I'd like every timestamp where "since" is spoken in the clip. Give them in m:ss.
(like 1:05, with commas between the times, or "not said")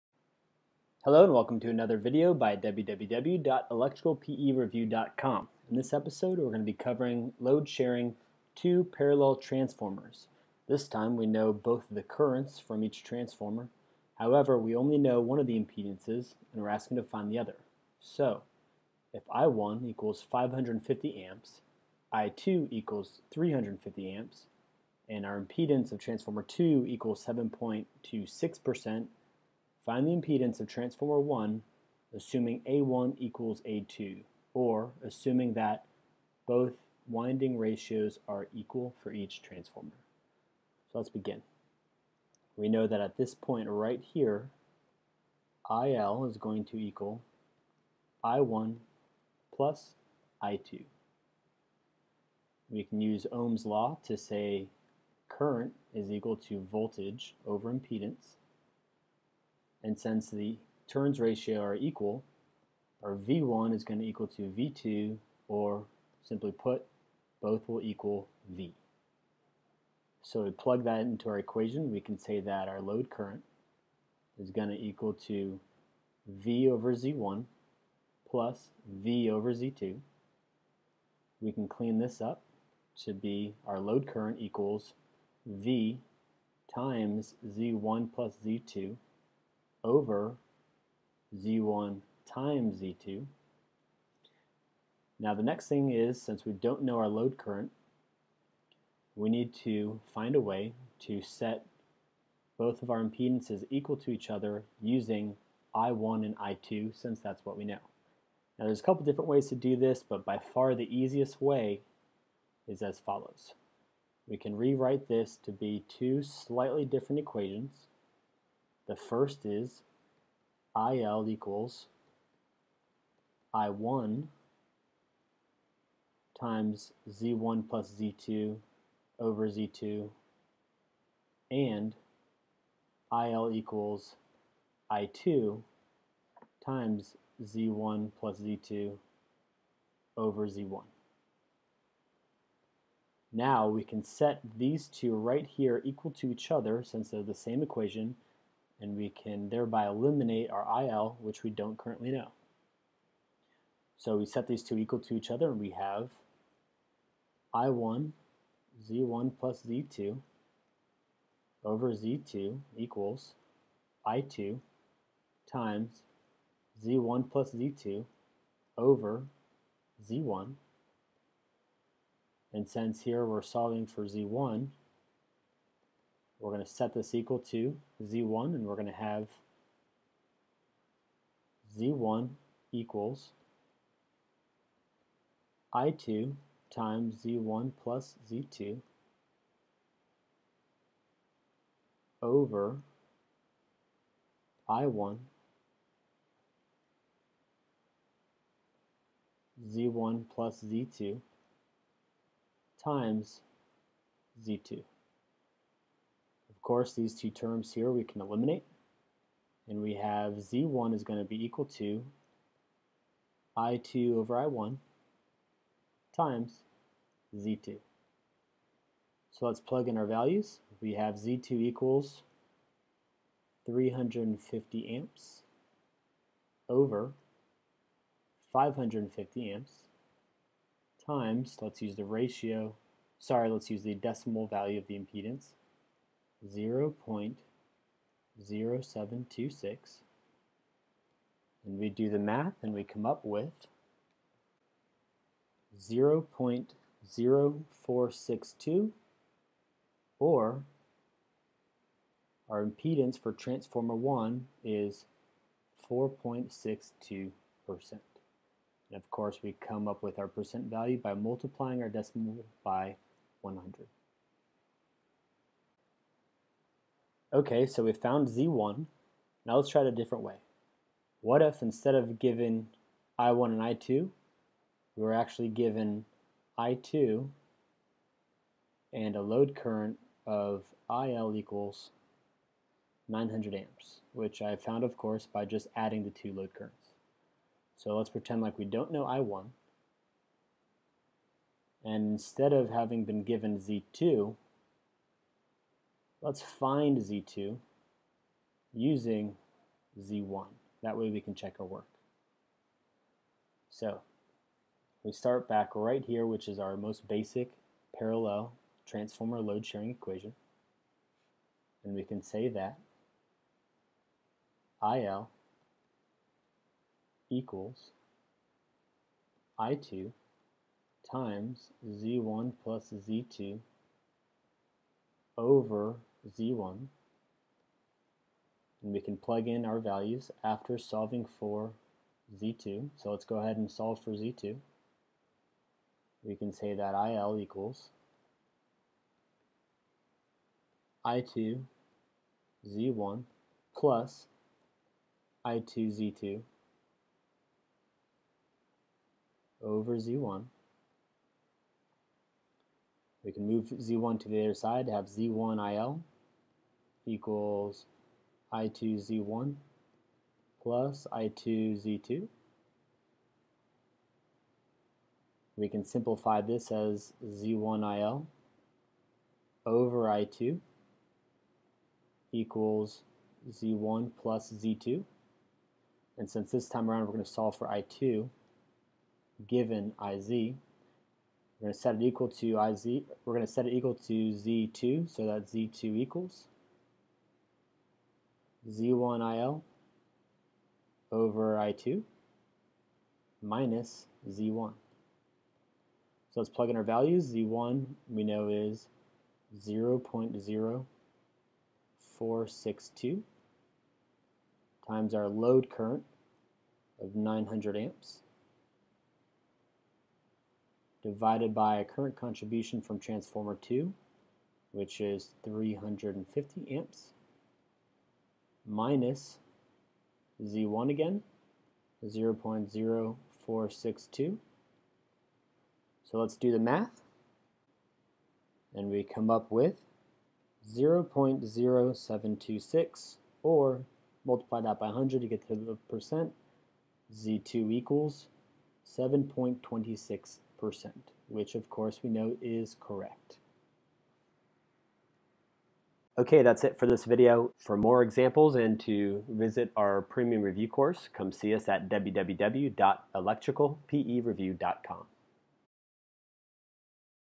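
0:59, 1:36, 1:46, 2:26, 2:52, 6:16.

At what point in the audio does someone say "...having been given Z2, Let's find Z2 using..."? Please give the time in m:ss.
4:52.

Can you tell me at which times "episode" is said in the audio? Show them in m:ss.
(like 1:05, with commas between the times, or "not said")
0:05.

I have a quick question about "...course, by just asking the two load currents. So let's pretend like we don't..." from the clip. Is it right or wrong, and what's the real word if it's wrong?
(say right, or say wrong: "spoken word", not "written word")
wrong: "adding", not "asking".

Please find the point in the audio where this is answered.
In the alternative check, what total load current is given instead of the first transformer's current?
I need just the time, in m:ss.
4:40.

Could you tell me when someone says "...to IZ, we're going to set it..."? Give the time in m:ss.
6:22.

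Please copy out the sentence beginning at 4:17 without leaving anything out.
And of course we come up with our percent value by multiplying our decimal by 100.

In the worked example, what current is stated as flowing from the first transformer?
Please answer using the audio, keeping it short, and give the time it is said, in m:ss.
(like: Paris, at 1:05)
550 amps, at 0:19.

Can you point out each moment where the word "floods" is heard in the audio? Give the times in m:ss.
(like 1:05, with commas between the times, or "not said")
not said.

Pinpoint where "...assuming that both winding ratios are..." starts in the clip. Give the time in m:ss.
0:35.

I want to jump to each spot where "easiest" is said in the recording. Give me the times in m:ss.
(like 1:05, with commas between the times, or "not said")
1:50.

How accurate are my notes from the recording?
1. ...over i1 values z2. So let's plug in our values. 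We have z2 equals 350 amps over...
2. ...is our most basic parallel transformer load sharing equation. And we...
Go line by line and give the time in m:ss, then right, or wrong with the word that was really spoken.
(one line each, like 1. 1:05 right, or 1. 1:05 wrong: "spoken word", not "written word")
1. 3:34 wrong: "times", not "values"
2. 5:06 right.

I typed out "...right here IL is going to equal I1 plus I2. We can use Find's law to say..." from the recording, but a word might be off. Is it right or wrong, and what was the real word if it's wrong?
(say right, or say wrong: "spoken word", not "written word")
wrong: "Ohm", not "Find".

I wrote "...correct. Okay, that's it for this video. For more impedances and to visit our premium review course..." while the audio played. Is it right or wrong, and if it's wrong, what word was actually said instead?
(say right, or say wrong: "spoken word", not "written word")
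wrong: "examples", not "impedances".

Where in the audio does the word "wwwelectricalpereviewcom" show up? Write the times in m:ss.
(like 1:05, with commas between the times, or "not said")
0:02, 7:31.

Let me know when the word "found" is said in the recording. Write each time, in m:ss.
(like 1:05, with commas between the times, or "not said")
4:27, 4:44.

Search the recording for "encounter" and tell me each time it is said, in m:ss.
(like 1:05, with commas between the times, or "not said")
not said.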